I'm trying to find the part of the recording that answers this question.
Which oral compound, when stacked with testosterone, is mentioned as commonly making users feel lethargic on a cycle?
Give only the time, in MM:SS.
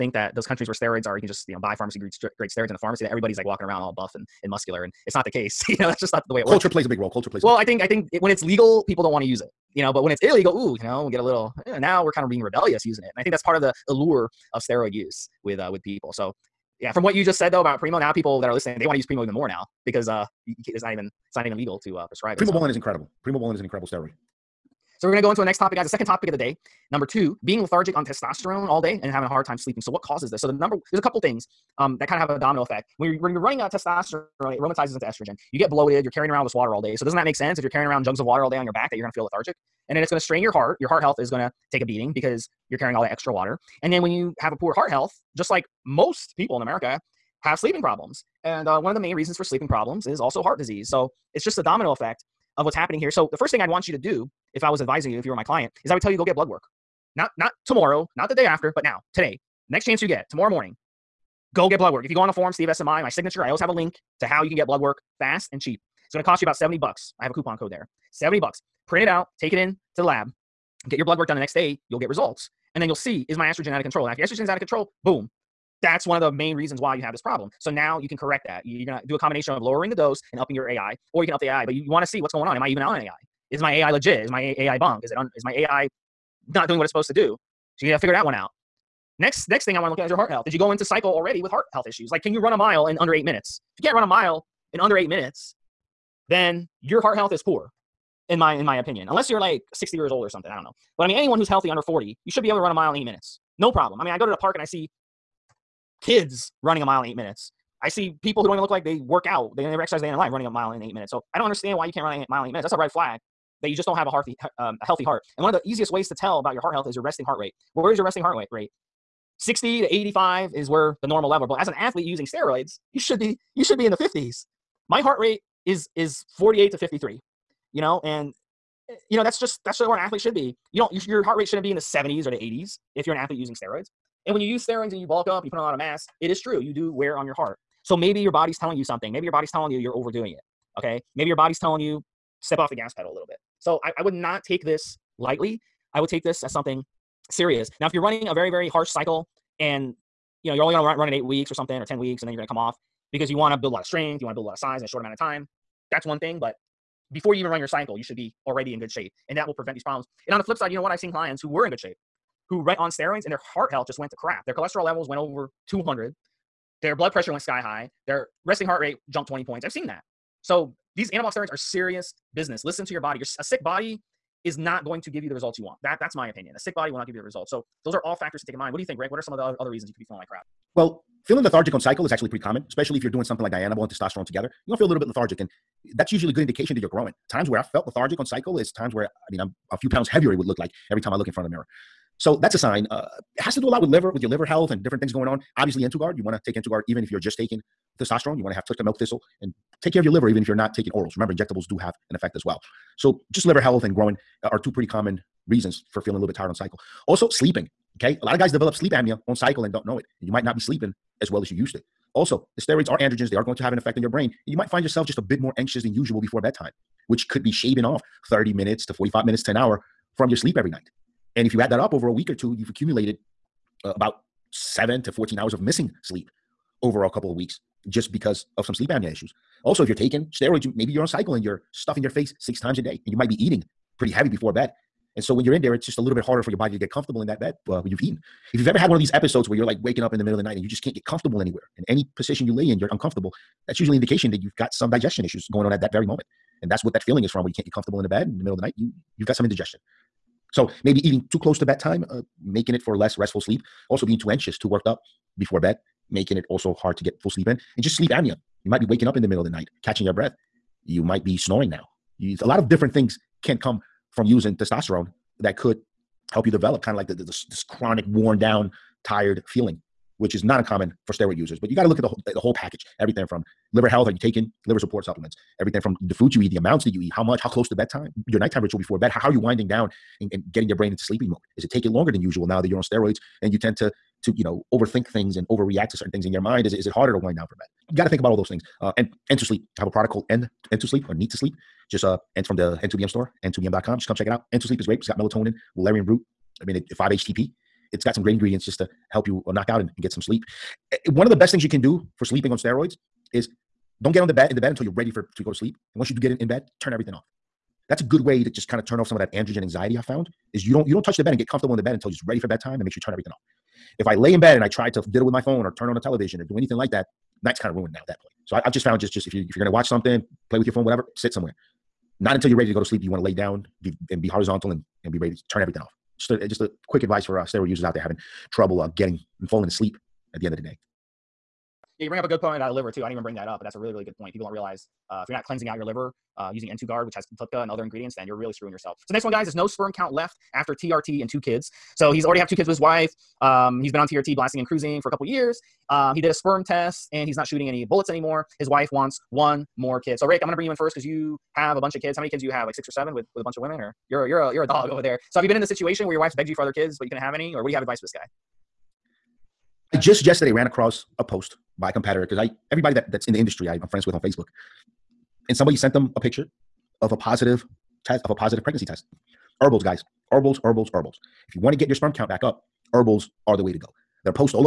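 03:03.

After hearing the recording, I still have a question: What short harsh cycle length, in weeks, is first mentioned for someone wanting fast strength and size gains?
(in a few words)
8 weeks.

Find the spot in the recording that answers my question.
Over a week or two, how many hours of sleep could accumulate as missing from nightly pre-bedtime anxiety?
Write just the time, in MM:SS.
03:44.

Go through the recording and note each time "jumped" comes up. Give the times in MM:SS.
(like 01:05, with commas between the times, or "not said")
02:49.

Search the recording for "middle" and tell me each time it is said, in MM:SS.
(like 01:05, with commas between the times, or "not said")
04:00, 04:08, 04:19.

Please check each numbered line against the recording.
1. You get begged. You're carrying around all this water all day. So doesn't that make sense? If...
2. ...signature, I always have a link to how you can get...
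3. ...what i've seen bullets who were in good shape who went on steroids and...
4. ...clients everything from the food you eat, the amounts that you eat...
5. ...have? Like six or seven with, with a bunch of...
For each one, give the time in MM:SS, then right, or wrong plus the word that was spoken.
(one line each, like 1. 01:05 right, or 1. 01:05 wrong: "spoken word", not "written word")
1. 00:35 wrong: "bloated", not "begged"
2. 01:03 right
3. 02:40 wrong: "clients", not "bullets"
4. 04:35 wrong: "supplements", not "clients"
5. 05:52 right.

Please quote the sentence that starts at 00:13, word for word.
And I think that's part of the allure of steroid use with uh, with people.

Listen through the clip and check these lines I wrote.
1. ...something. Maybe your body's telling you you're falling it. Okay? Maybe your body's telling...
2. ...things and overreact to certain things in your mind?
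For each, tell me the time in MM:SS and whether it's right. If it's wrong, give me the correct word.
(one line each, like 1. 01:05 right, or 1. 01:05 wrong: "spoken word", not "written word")
1. 02:18 wrong: "overdoing", not "falling"
2. 04:45 right.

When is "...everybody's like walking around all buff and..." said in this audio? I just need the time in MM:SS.
00:03.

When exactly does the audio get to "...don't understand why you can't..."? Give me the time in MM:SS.
01:51.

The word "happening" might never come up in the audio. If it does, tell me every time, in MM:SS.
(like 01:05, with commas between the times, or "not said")
00:52.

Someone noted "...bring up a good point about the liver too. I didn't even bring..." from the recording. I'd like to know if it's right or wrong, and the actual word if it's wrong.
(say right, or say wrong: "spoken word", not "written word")
right.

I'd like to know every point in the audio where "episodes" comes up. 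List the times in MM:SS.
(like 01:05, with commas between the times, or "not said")
03:59.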